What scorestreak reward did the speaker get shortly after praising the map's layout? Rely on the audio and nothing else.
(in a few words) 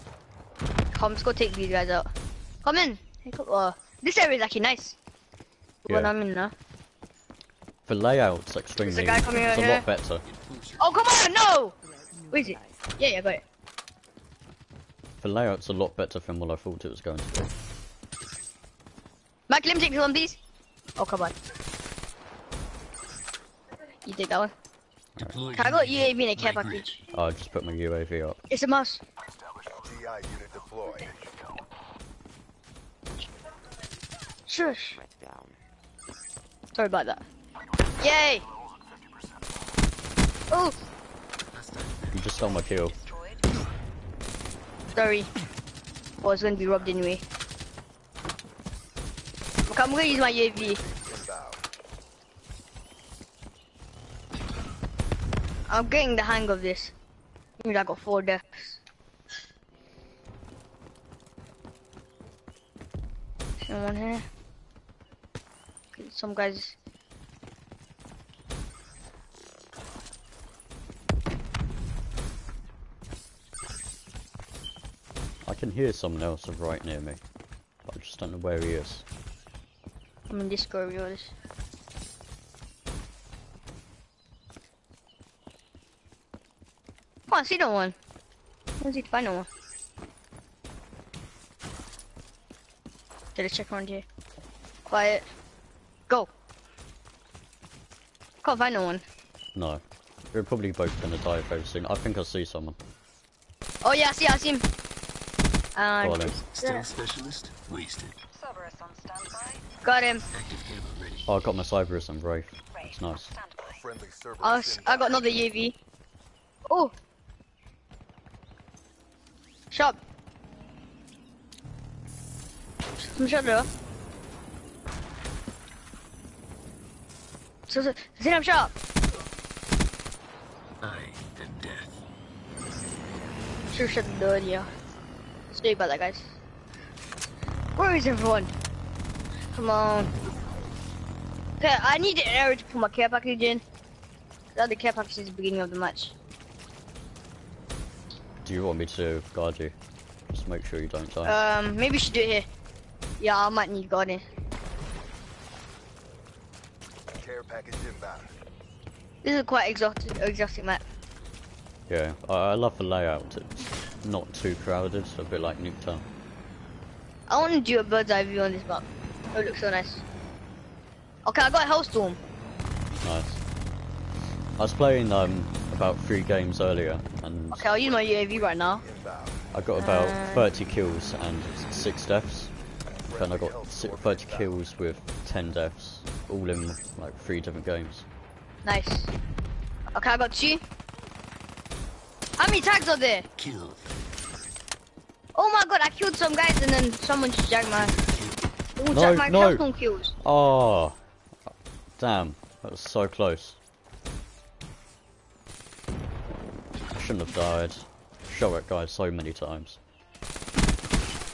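Hellstorm.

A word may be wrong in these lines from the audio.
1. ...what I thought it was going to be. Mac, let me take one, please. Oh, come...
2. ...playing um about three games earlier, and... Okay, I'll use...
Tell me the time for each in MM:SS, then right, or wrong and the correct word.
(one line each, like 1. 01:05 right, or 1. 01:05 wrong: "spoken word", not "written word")
1. 00:16 right
2. 02:54 right.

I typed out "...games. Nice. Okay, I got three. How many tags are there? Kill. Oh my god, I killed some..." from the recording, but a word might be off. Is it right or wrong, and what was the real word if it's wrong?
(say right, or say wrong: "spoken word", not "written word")
wrong: "two", not "three".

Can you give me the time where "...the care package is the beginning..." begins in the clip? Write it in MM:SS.
02:24.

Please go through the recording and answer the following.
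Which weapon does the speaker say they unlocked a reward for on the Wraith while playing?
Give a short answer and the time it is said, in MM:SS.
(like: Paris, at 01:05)
Cerberus, at 01:51.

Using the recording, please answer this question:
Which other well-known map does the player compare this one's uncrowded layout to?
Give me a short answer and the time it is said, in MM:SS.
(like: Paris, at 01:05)
Nuketown, at 02:45.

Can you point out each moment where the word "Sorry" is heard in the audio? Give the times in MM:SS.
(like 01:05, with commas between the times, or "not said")
00:36, 02:15.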